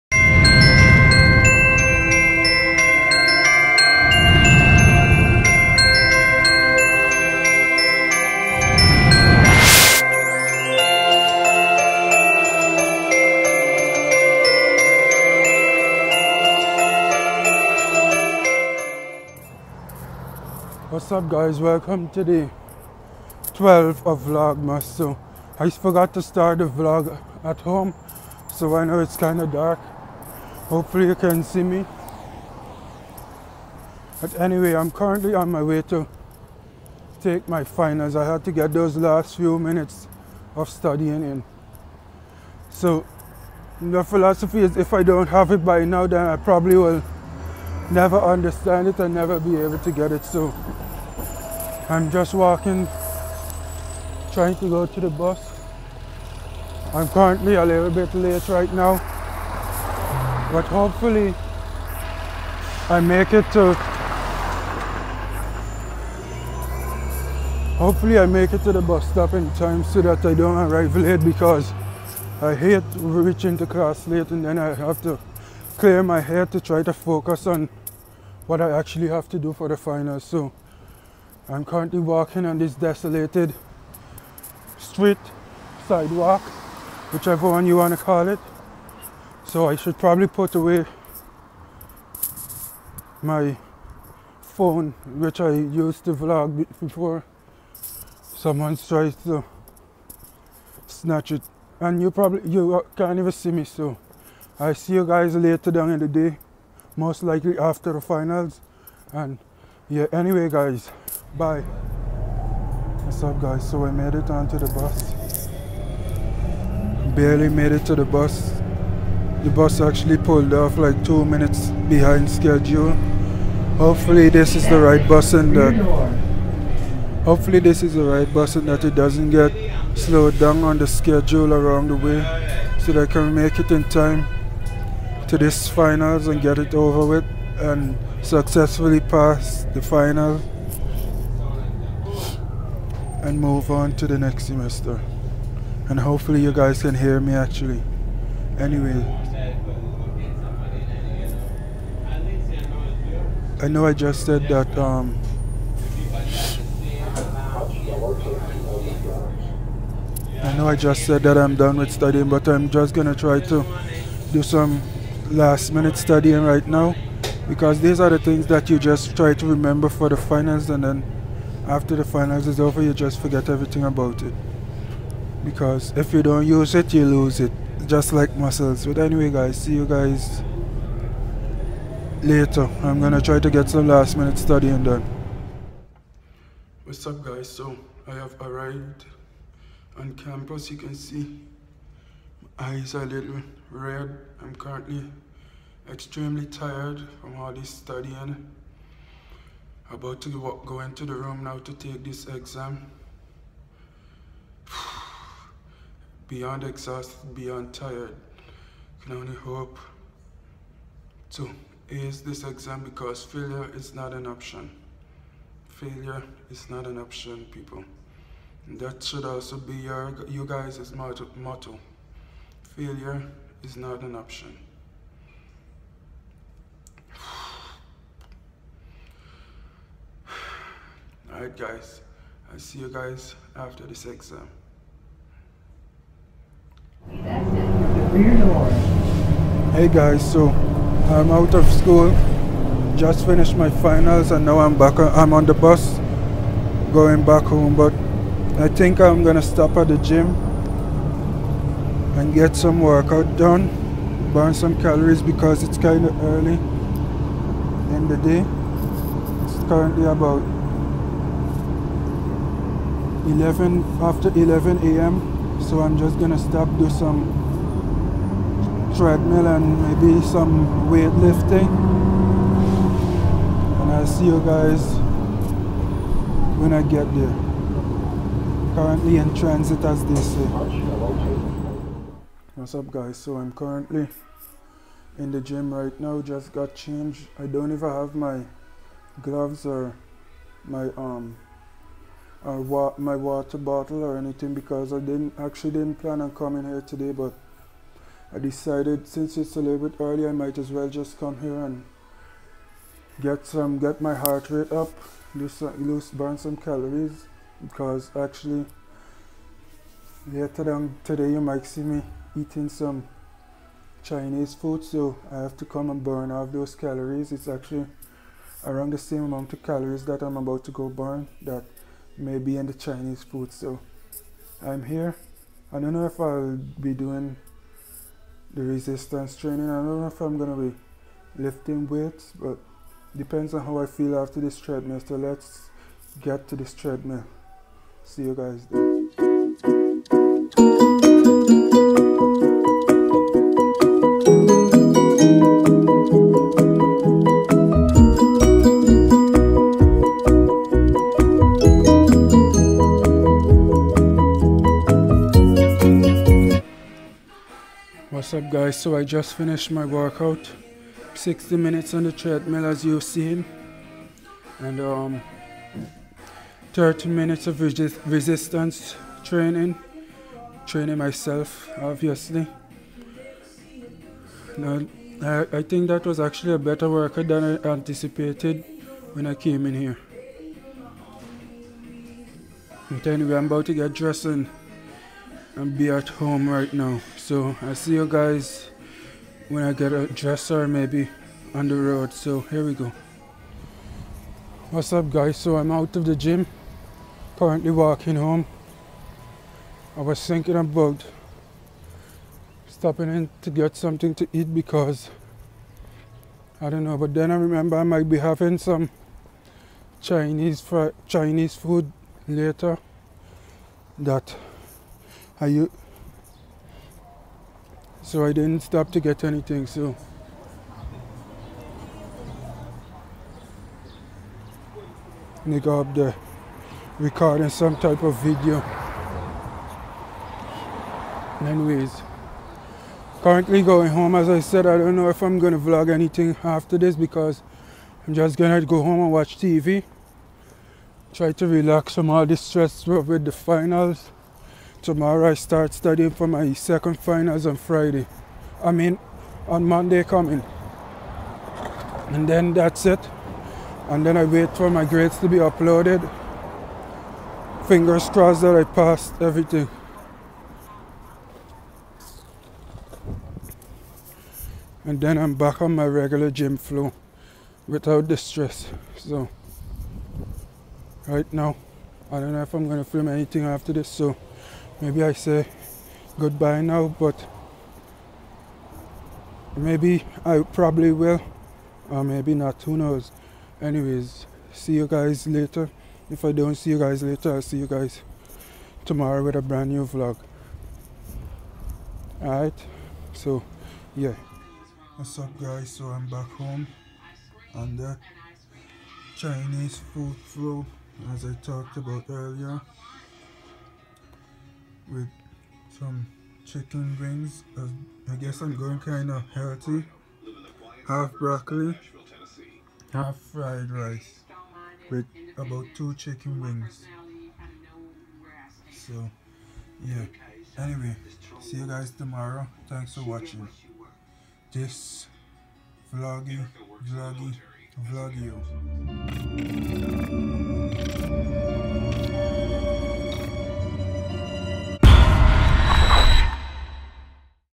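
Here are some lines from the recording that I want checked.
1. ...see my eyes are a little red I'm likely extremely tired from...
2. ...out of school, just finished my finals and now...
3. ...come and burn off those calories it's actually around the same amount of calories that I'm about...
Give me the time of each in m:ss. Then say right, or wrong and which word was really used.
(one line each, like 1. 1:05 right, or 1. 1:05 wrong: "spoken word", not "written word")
1. 3:10 wrong: "currently", not "likely"
2. 4:01 right
3. 5:15 right.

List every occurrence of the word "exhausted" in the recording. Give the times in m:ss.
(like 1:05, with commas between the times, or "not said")
3:26.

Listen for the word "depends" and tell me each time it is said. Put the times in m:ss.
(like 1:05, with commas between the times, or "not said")
5:33.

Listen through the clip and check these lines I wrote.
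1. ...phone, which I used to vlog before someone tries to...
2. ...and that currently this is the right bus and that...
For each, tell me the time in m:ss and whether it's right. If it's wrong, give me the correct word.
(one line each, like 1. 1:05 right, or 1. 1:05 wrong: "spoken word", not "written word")
1. 1:34 right
2. 2:05 wrong: "hopefully", not "currently".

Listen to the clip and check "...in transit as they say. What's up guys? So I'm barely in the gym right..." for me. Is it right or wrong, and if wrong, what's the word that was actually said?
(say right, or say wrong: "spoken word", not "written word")
wrong: "currently", not "barely".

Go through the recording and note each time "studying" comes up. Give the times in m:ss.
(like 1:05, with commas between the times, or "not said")
0:40, 2:41, 2:45, 3:04, 3:17, 7:25.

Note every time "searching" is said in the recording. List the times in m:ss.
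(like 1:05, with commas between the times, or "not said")
not said.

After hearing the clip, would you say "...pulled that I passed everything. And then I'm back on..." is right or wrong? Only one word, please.
wrong.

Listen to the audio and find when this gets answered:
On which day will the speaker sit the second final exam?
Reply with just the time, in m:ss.
7:29.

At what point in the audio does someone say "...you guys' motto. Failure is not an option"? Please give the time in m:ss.
3:40.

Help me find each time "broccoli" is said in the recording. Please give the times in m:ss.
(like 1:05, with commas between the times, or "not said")
8:31.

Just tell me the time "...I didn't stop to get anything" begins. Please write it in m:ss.
6:58.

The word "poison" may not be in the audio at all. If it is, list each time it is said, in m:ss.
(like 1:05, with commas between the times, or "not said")
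not said.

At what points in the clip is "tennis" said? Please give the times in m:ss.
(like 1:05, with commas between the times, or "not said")
not said.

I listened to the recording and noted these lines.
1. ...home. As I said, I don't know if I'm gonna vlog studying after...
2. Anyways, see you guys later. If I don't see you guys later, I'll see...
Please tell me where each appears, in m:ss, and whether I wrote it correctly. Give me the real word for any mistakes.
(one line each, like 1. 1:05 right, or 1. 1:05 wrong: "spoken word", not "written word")
1. 7:13 wrong: "anything", not "studying"
2. 8:03 right.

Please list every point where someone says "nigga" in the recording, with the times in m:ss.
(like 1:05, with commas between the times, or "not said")
7:05.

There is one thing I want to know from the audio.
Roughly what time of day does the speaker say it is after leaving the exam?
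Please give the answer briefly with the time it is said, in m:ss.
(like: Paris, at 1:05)
11 a.m., at 4:24.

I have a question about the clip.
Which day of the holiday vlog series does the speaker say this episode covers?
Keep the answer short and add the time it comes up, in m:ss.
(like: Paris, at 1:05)
12th, at 0:23.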